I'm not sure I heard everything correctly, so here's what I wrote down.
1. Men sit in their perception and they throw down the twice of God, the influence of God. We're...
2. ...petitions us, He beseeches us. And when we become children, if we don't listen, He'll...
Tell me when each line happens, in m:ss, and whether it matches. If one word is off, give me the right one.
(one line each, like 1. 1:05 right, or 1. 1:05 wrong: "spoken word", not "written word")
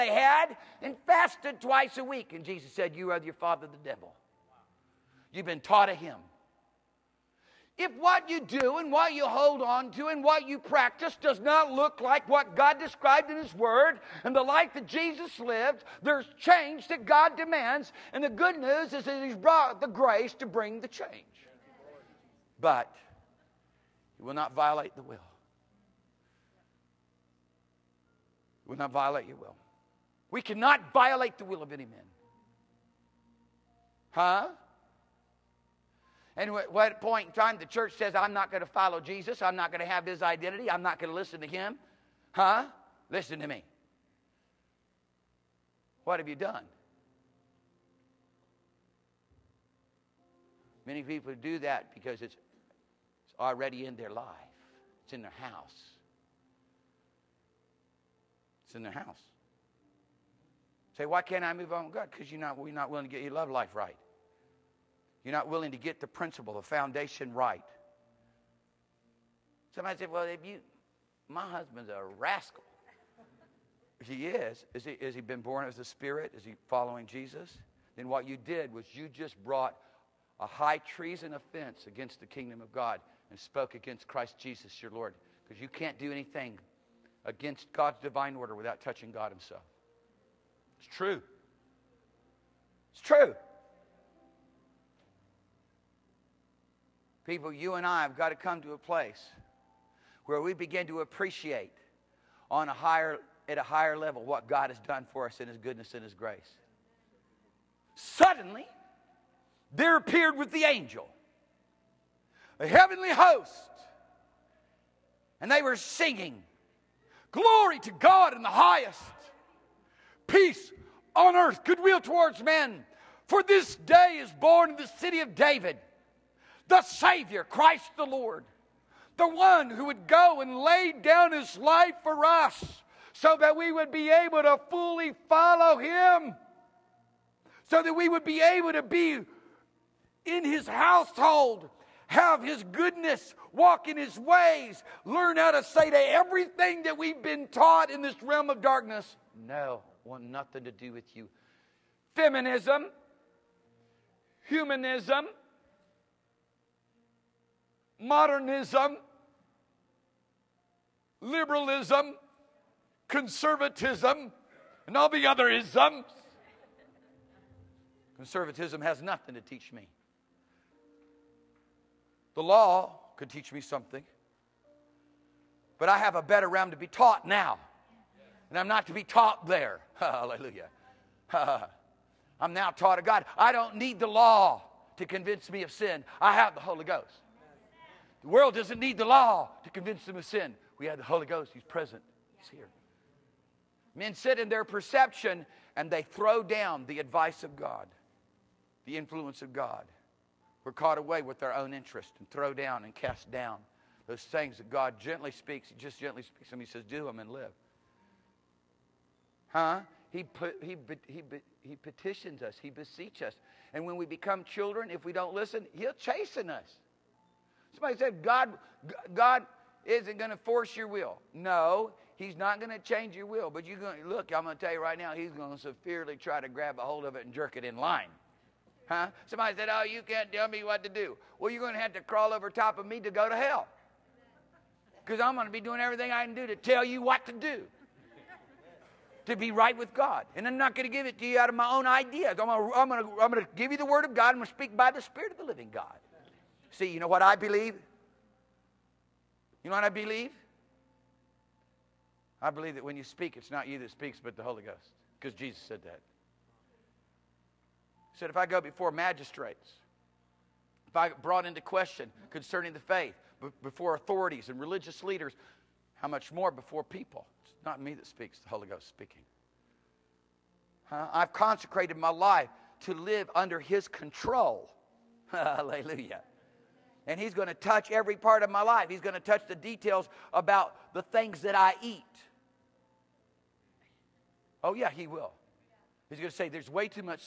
1. 3:13 wrong: "advice", not "twice"
2. 3:31 right.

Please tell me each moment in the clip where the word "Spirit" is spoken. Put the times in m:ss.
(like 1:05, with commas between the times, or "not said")
1:15, 4:04.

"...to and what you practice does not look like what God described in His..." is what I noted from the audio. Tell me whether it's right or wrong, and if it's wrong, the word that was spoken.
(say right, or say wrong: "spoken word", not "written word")
right.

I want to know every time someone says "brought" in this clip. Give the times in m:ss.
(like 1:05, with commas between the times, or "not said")
0:19, 1:19, 4:21.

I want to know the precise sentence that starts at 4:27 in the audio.
It's not me that speaks, the Holy Ghost speaking.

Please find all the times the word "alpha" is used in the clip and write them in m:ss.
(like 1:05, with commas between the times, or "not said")
not said.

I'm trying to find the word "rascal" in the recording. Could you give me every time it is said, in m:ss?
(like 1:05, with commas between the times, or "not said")
1:12.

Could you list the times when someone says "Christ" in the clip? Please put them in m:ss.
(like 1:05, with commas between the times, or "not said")
1:24, 2:07.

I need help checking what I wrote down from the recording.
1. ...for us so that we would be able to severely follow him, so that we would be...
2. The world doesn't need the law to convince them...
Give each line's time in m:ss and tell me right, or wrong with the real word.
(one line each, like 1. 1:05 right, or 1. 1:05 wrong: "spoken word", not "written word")
1. 2:12 wrong: "fully", not "severely"
2. 3:08 right.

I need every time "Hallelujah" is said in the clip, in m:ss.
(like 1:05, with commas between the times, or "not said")
2:59, 4:35.